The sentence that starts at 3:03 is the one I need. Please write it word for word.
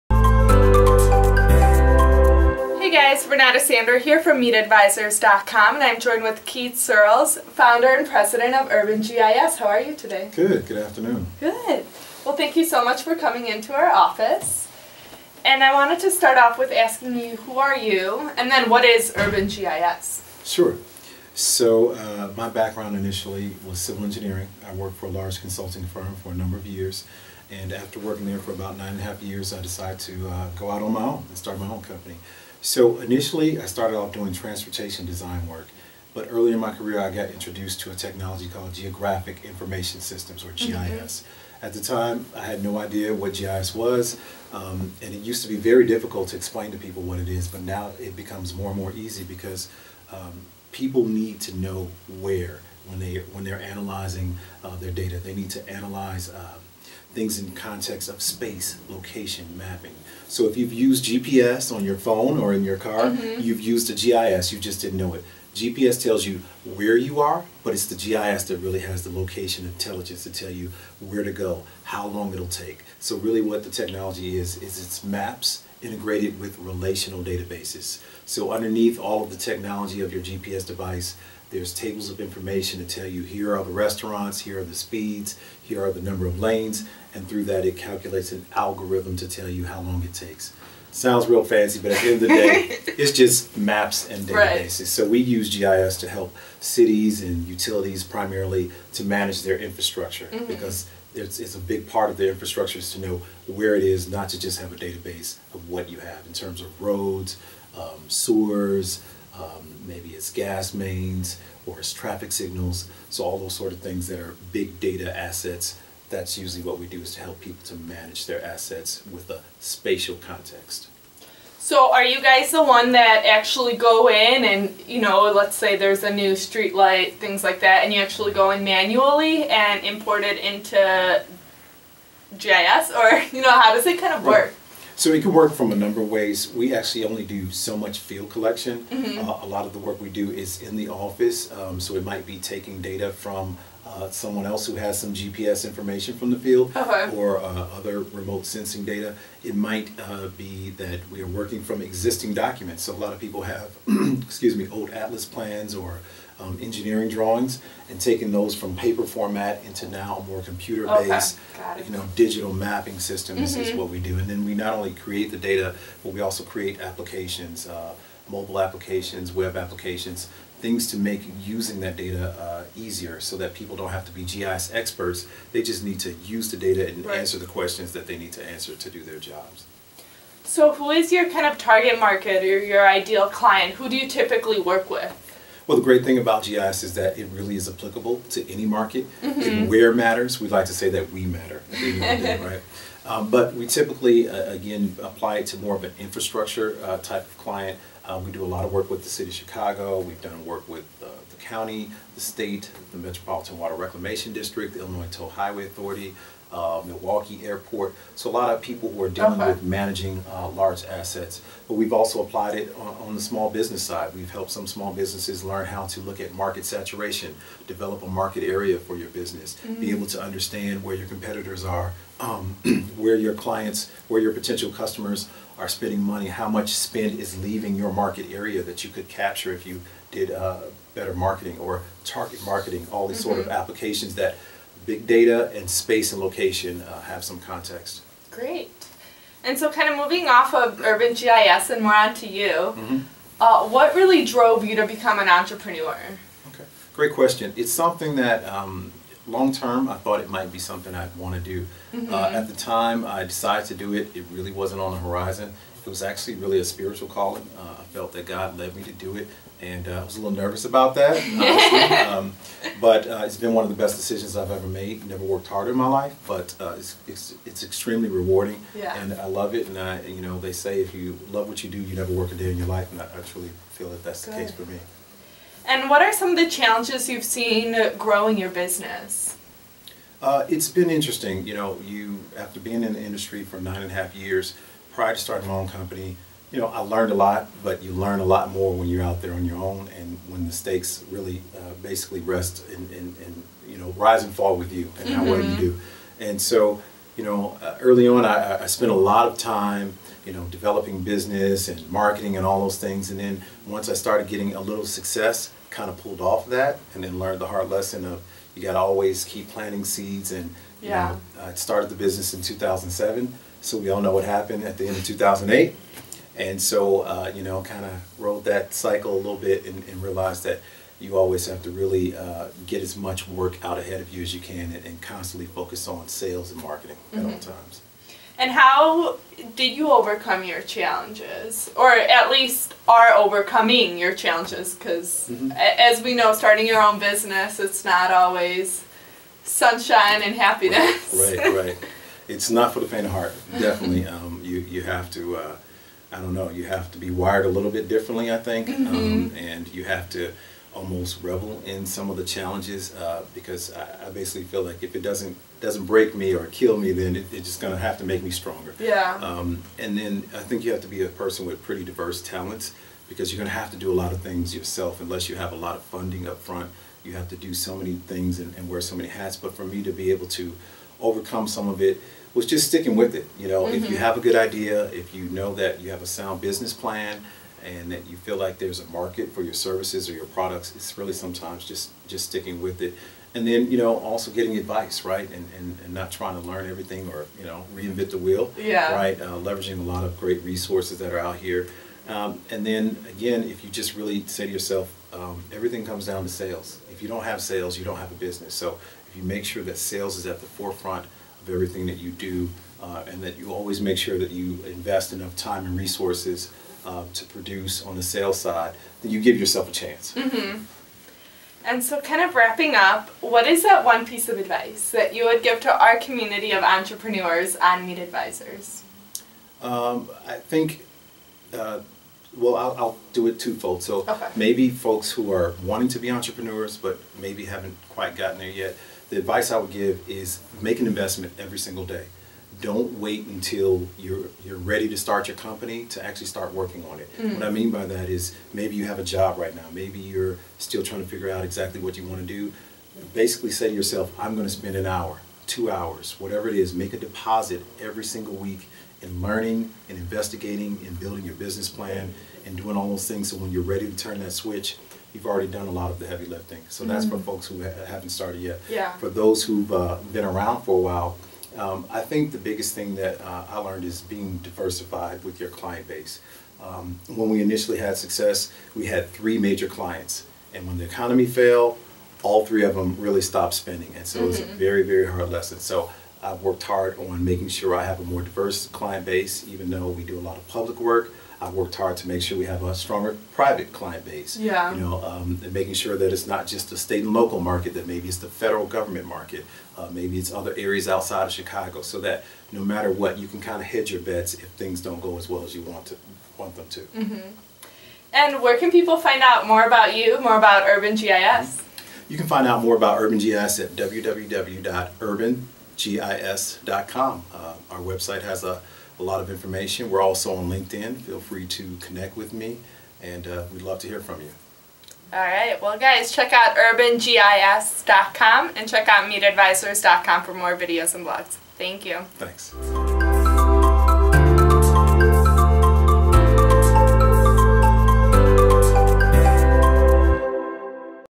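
Who do you typically work with?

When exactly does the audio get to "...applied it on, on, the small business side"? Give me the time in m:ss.
3:32.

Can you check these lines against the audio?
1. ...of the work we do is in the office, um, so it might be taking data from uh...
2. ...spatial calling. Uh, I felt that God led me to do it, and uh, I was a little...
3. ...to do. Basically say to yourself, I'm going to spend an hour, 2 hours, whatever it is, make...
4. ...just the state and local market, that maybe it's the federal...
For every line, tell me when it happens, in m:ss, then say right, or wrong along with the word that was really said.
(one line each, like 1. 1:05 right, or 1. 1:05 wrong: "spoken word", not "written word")
1. 2:19 right
2. 4:16 wrong: "spiritual", not "spatial"
3. 7:22 right
4. 8:06 right.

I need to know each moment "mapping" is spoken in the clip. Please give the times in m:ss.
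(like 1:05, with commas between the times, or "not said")
0:59, 2:42.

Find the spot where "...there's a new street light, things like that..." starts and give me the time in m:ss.
2:05.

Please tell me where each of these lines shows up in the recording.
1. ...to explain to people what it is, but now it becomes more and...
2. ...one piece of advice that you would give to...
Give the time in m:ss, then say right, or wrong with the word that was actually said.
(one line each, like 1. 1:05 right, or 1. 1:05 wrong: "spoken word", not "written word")
1. 0:46 right
2. 6:53 right.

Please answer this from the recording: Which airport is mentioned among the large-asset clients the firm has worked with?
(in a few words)
Milwaukee Airport.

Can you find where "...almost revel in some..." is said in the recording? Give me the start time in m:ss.
5:50.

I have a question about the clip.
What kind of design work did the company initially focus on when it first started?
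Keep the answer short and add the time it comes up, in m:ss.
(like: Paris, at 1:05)
transportation design, at 0:34.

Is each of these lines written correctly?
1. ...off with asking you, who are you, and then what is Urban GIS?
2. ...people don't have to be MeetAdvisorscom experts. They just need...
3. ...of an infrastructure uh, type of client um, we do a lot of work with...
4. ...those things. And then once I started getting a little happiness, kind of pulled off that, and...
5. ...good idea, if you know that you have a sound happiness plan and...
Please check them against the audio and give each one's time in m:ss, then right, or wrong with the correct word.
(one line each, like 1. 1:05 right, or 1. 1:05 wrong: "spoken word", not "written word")
1. 0:16 right
2. 2:53 wrong: "GIS", not "MeetAdvisorscom"
3. 3:15 right
4. 5:02 wrong: "success", not "happiness"
5. 6:14 wrong: "business", not "happiness".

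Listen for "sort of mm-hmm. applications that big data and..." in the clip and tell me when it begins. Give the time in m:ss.
3:53.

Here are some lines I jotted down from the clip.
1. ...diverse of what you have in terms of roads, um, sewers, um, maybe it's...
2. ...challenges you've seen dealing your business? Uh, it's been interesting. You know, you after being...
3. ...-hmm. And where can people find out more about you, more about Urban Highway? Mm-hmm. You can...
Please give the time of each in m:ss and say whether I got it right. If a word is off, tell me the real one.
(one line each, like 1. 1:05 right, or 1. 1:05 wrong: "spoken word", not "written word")
1. 1:44 wrong: "database", not "diverse"
2. 4:36 wrong: "growing", not "dealing"
3. 8:17 wrong: "GIS", not "Highway".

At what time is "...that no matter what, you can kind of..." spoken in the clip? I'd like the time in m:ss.
8:12.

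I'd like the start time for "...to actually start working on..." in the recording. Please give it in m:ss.
7:15.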